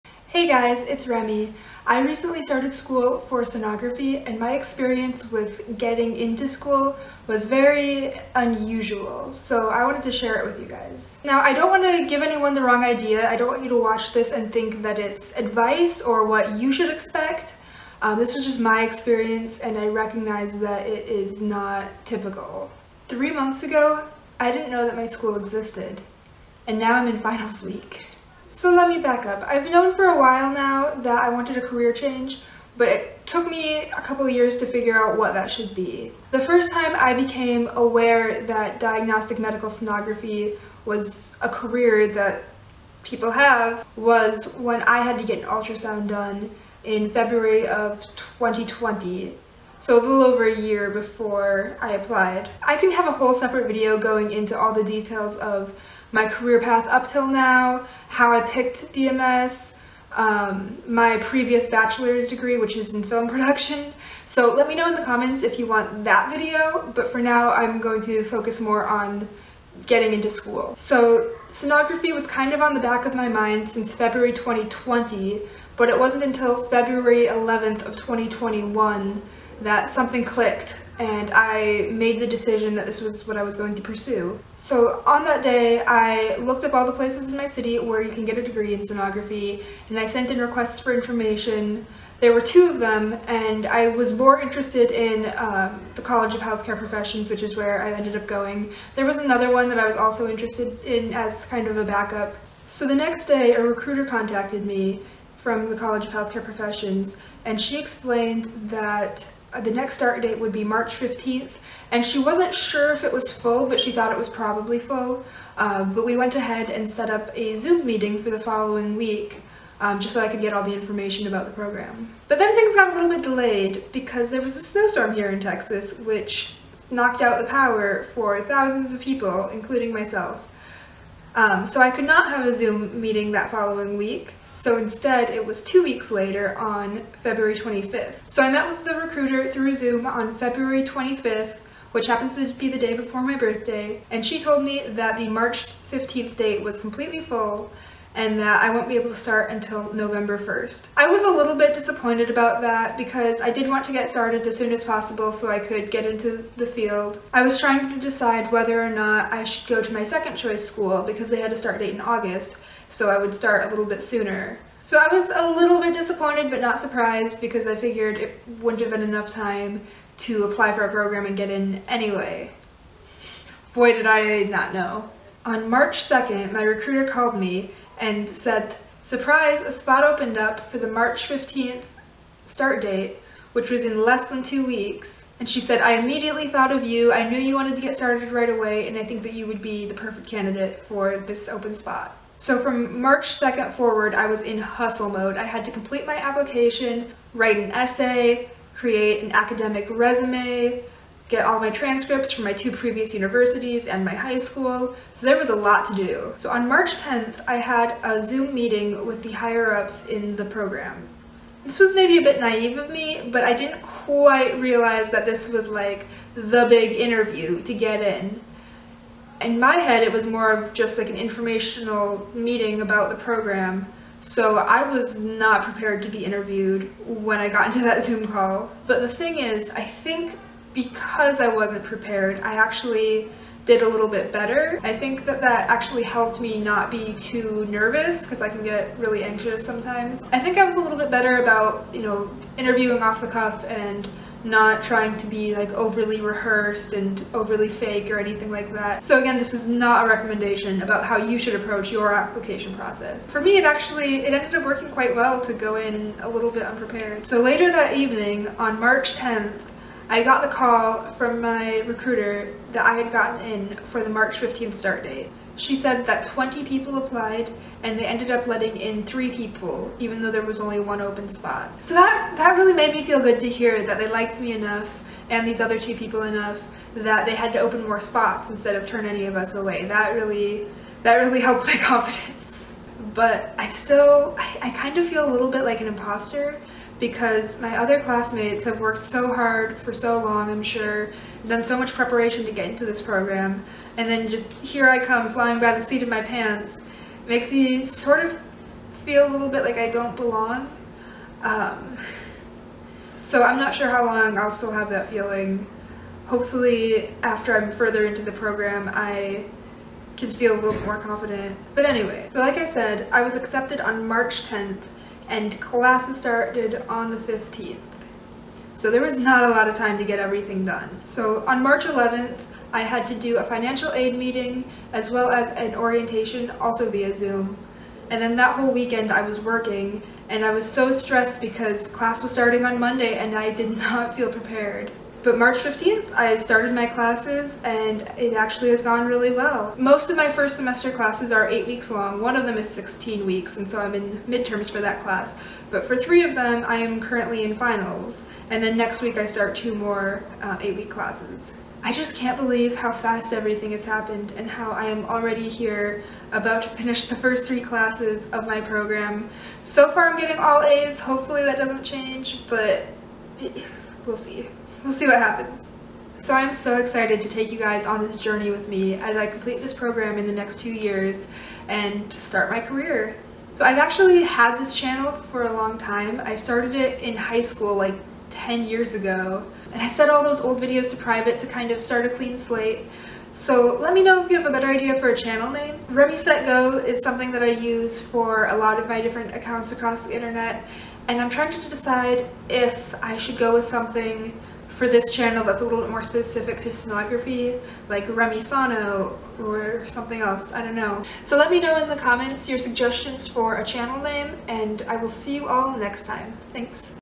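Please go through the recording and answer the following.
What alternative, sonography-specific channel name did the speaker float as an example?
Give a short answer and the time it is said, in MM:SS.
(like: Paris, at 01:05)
Remy Sono, at 06:38.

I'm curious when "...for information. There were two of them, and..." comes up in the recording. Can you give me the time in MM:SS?
01:30.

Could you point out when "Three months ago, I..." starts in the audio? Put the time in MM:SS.
00:23.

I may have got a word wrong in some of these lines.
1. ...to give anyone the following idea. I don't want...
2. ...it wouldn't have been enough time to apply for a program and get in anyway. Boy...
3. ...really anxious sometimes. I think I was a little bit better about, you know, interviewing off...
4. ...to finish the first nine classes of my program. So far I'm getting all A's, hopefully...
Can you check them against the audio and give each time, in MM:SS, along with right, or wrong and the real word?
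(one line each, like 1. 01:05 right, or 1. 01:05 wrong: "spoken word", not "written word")
1. 00:11 wrong: "wrong", not "following"
2. 02:48 right
3. 03:58 right
4. 05:56 wrong: "three", not "nine".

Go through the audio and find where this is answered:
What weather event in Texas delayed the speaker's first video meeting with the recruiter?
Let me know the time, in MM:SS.
02:04.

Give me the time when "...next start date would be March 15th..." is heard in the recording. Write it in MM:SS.
01:49.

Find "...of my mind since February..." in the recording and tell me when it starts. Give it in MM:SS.
01:13.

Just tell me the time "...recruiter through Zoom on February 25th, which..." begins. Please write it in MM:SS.
02:18.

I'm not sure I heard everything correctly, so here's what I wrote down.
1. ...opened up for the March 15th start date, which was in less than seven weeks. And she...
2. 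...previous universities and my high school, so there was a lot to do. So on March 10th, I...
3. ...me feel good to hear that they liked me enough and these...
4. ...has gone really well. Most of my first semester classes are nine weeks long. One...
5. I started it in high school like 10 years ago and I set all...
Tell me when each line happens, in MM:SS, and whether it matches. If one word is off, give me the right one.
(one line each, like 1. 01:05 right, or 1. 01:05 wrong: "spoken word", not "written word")
1. 03:00 wrong: "two", not "seven"
2. 03:22 right
3. 04:32 right
4. 05:38 wrong: "eight", not "nine"
5. 06:16 right.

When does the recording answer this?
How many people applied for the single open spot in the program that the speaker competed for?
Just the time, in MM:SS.
04:26.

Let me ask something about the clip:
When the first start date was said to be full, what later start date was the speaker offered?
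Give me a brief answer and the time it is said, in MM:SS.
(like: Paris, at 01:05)
November 1st, at 02:29.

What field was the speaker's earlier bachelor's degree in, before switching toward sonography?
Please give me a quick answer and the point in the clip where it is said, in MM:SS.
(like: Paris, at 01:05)
Film production, at 01:03.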